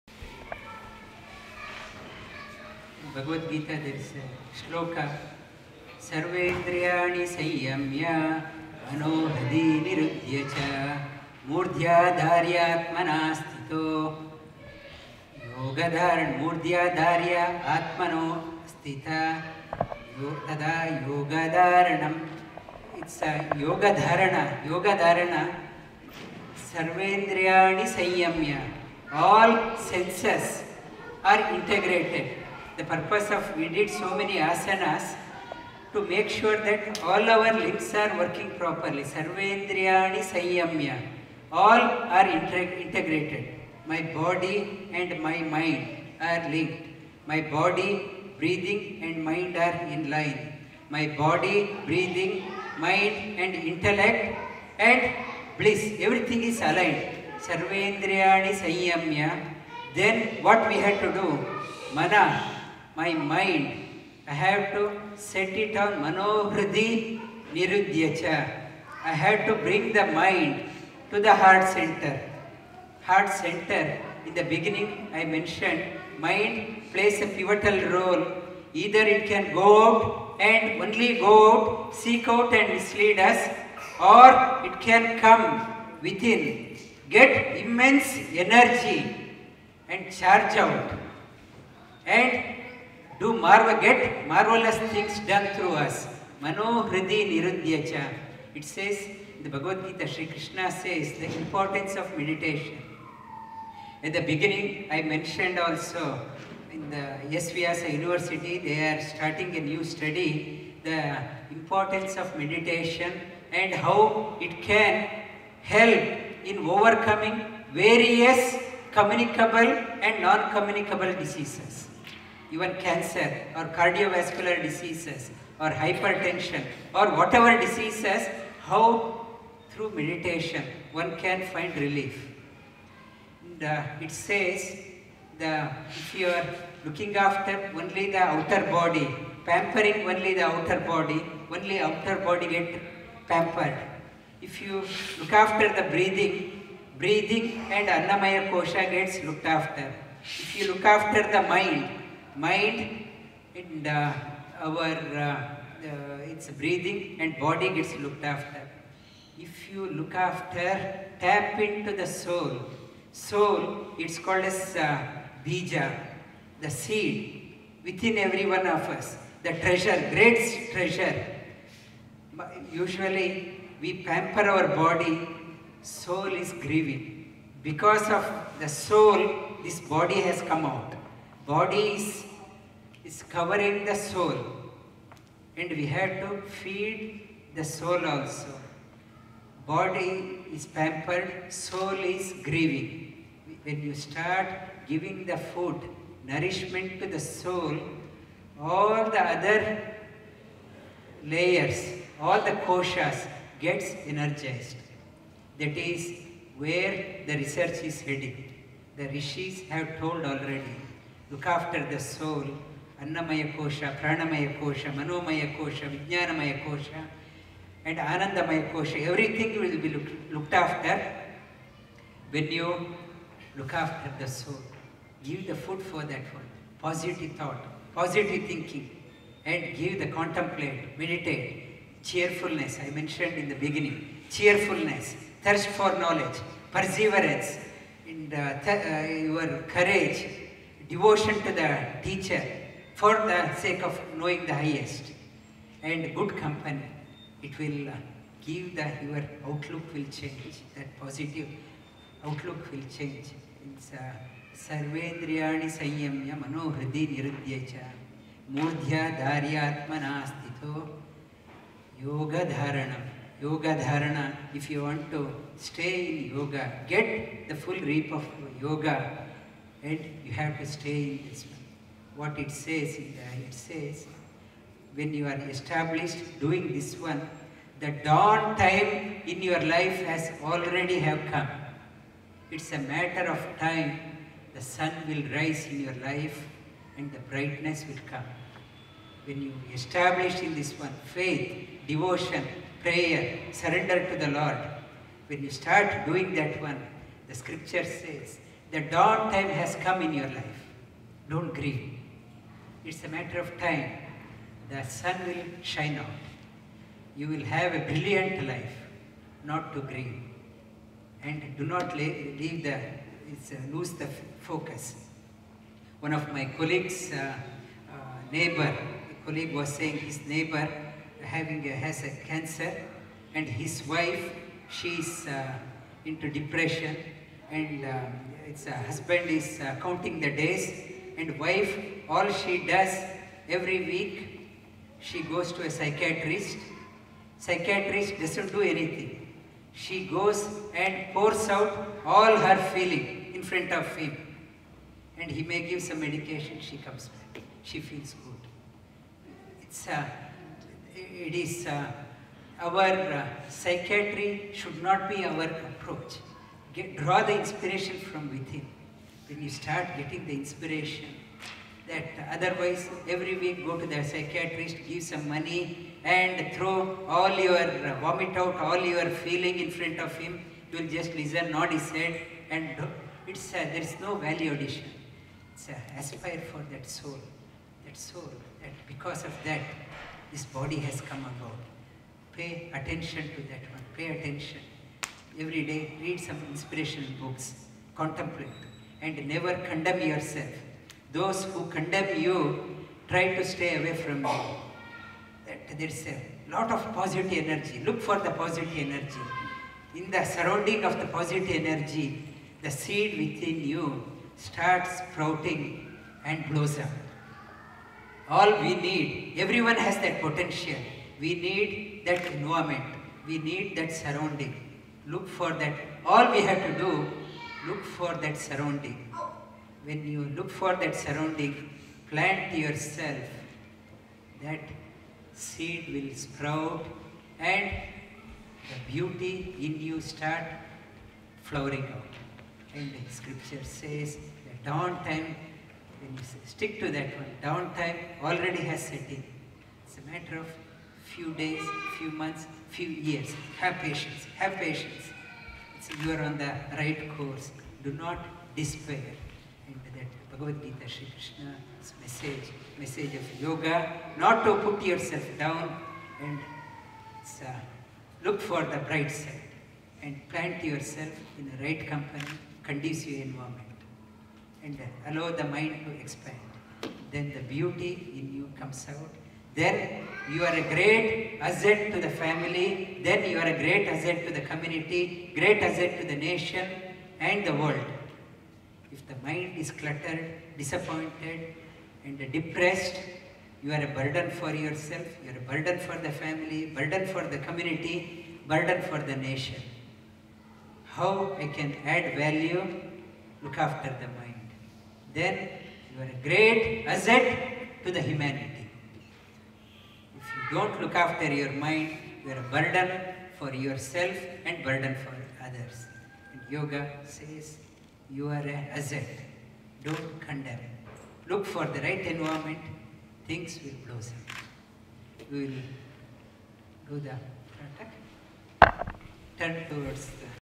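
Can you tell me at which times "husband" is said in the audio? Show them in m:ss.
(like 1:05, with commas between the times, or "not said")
5:28.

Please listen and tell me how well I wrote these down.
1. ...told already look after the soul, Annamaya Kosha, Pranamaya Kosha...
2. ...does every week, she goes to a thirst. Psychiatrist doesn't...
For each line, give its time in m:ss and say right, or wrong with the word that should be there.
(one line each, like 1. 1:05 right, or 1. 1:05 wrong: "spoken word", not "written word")
1. 3:29 right
2. 5:32 wrong: "psychiatrist", not "thirst".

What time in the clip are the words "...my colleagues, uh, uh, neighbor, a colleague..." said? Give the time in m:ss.
5:16.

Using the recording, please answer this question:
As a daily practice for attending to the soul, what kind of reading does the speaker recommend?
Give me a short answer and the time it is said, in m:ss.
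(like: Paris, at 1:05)
inspirational books, at 6:26.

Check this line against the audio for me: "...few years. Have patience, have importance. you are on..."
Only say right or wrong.
wrong.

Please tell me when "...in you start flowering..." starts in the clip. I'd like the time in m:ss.
7:09.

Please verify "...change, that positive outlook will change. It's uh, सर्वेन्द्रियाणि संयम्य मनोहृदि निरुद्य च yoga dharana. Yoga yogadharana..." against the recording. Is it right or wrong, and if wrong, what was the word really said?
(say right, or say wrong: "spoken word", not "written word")
right.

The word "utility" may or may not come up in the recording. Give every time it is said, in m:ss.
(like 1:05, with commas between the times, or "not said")
not said.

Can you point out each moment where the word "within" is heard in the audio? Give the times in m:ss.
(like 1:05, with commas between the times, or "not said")
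1:26, 2:47, 5:58, 6:43.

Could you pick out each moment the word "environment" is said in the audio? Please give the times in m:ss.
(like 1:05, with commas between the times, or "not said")
6:52, 7:43, 8:32.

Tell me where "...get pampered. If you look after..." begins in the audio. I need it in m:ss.
2:22.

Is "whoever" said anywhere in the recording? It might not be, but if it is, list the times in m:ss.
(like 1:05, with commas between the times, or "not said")
not said.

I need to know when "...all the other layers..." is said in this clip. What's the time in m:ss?
3:18.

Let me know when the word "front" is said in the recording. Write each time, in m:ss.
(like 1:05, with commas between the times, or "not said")
5:43, 6:09.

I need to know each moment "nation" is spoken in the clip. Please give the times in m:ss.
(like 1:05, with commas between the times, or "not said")
7:56, 8:09.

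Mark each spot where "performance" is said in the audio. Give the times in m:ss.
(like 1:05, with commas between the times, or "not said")
not said.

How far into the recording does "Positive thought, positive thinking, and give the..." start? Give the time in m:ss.
3:46.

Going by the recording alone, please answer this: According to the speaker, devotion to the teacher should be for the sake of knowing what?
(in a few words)
the highest.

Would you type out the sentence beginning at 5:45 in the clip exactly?
And he may give some medication, she comes back.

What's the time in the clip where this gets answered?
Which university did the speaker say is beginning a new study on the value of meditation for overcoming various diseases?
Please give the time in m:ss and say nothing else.
1:47.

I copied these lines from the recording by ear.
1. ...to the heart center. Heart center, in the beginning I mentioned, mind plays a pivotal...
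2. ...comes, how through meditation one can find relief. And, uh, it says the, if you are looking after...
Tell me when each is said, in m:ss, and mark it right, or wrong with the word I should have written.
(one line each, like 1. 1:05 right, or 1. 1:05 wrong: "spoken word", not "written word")
1. 1:11 right
2. 2:07 wrong: "diseases", not "comes".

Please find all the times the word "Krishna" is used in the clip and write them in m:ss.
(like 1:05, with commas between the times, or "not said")
1:40, 7:31.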